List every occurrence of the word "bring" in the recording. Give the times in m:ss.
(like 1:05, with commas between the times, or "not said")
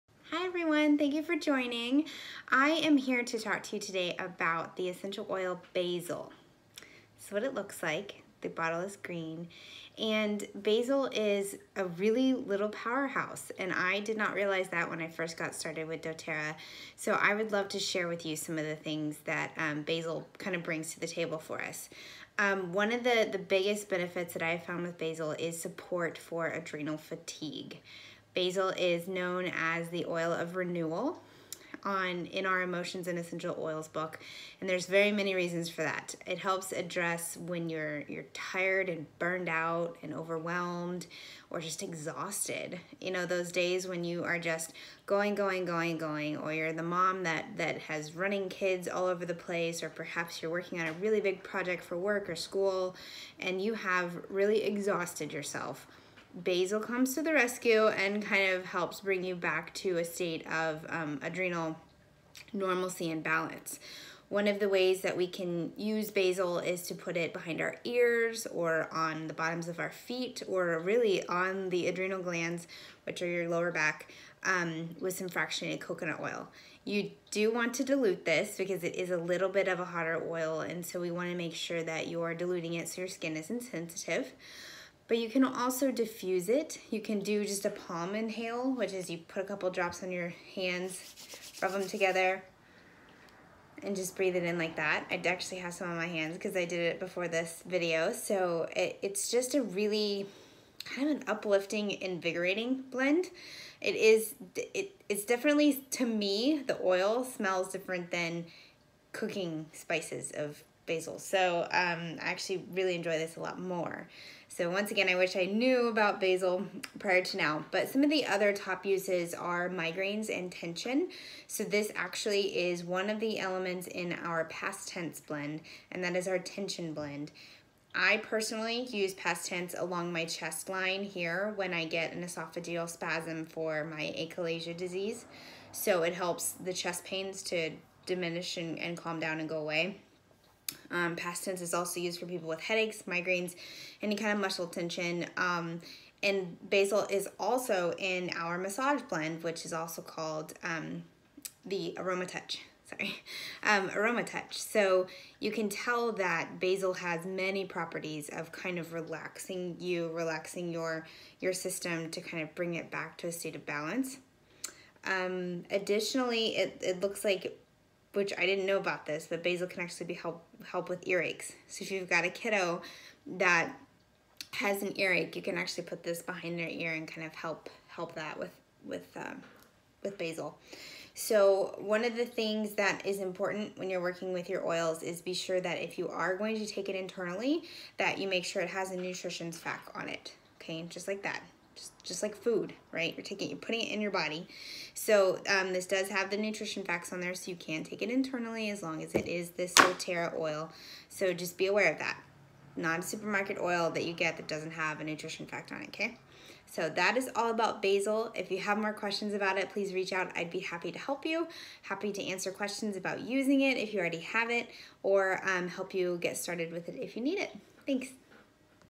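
0:20, 0:59, 2:42.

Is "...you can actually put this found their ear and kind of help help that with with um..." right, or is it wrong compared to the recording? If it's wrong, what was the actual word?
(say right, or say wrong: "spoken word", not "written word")
wrong: "behind", not "found".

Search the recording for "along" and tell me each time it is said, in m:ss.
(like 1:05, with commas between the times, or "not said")
2:09.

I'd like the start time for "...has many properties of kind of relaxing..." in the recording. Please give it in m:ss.
2:36.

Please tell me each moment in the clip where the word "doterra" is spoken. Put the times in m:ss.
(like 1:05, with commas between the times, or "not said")
0:16, 3:19.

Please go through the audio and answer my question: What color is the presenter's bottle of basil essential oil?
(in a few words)
Green.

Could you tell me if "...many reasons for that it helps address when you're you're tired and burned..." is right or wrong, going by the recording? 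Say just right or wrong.
right.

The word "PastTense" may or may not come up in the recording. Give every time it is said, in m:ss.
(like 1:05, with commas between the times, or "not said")
2:04, 2:09, 2:21.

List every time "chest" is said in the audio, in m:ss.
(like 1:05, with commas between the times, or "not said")
2:10, 2:16.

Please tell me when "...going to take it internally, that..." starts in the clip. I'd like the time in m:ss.
3:06.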